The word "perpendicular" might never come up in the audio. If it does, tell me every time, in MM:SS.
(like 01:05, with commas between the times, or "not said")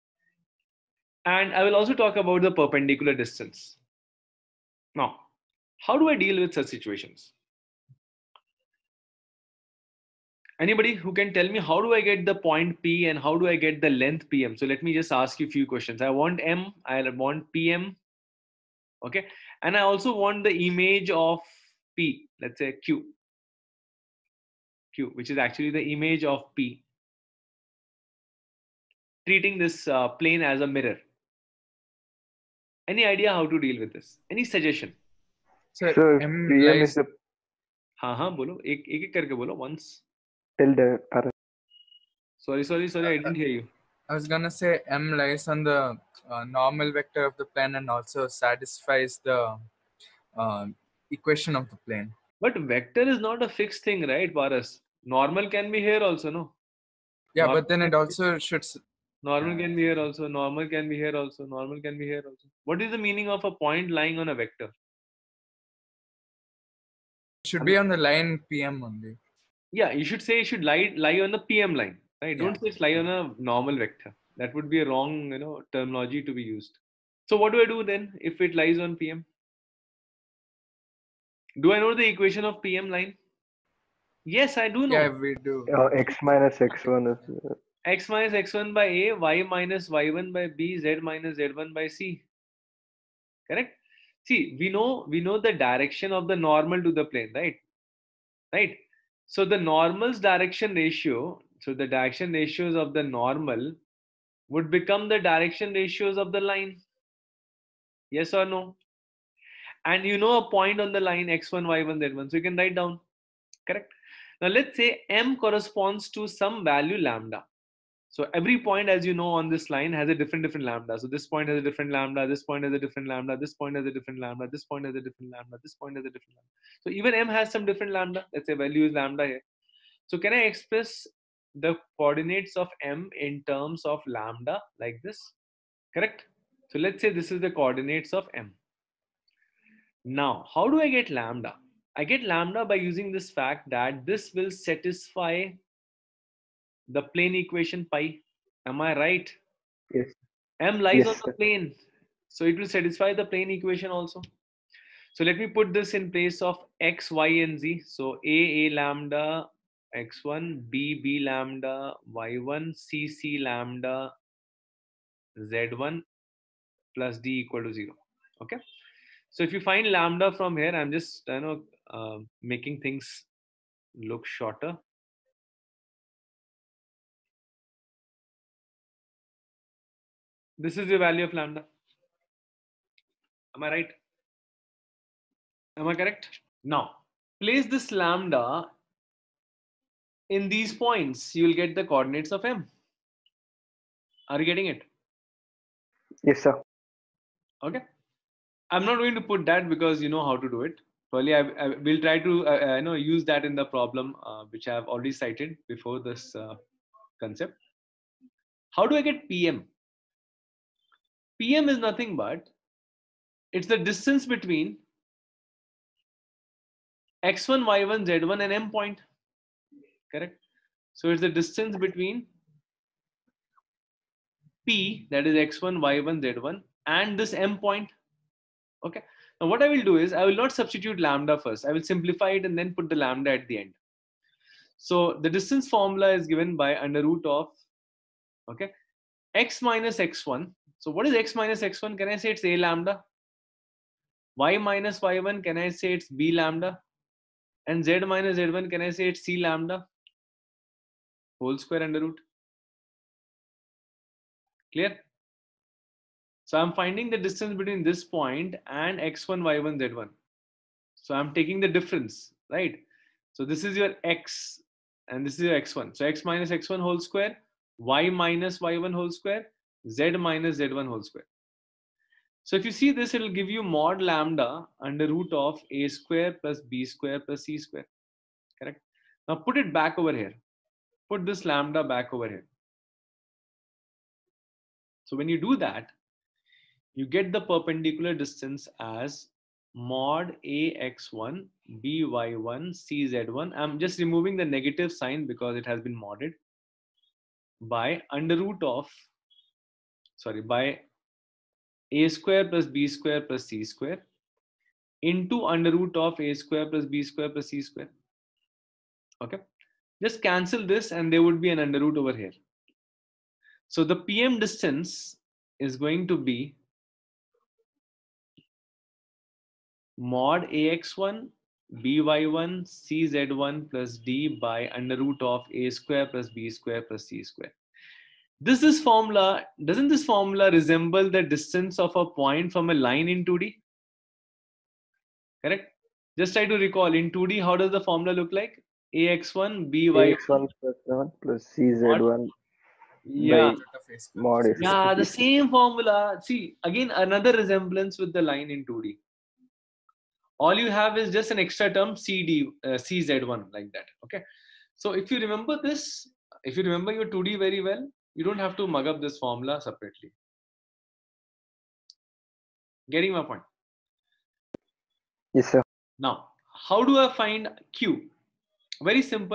00:02, 04:47.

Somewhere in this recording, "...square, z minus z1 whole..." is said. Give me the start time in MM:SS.
04:29.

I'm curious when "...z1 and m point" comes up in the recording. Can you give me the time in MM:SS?
03:38.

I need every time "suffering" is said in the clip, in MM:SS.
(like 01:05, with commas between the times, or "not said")
not said.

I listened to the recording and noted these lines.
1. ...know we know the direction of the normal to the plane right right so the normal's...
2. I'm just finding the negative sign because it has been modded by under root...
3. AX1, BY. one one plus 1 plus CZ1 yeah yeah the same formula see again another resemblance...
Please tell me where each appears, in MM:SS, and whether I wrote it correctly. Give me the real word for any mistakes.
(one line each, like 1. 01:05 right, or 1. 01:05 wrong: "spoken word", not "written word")
1. 01:34 right
2. 04:53 wrong: "removing", not "finding"
3. 05:38 right.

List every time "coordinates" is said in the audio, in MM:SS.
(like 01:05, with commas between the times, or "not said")
02:11, 02:17, 03:11.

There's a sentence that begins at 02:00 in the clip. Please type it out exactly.
So this point has a different lambda.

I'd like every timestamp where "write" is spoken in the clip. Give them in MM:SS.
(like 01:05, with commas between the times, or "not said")
01:52.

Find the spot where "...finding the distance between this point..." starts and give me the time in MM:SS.
04:16.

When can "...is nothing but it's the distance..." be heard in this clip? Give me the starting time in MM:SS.
03:31.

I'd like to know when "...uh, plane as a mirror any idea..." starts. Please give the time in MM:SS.
00:29.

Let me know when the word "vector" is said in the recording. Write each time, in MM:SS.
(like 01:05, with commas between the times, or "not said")
00:46, 00:52, 01:04, 01:13.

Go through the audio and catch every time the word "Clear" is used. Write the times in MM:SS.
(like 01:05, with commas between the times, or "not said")
04:14.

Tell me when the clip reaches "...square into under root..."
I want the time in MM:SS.
05:03.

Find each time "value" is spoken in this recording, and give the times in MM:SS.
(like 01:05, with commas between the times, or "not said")
01:56, 02:08, 03:00.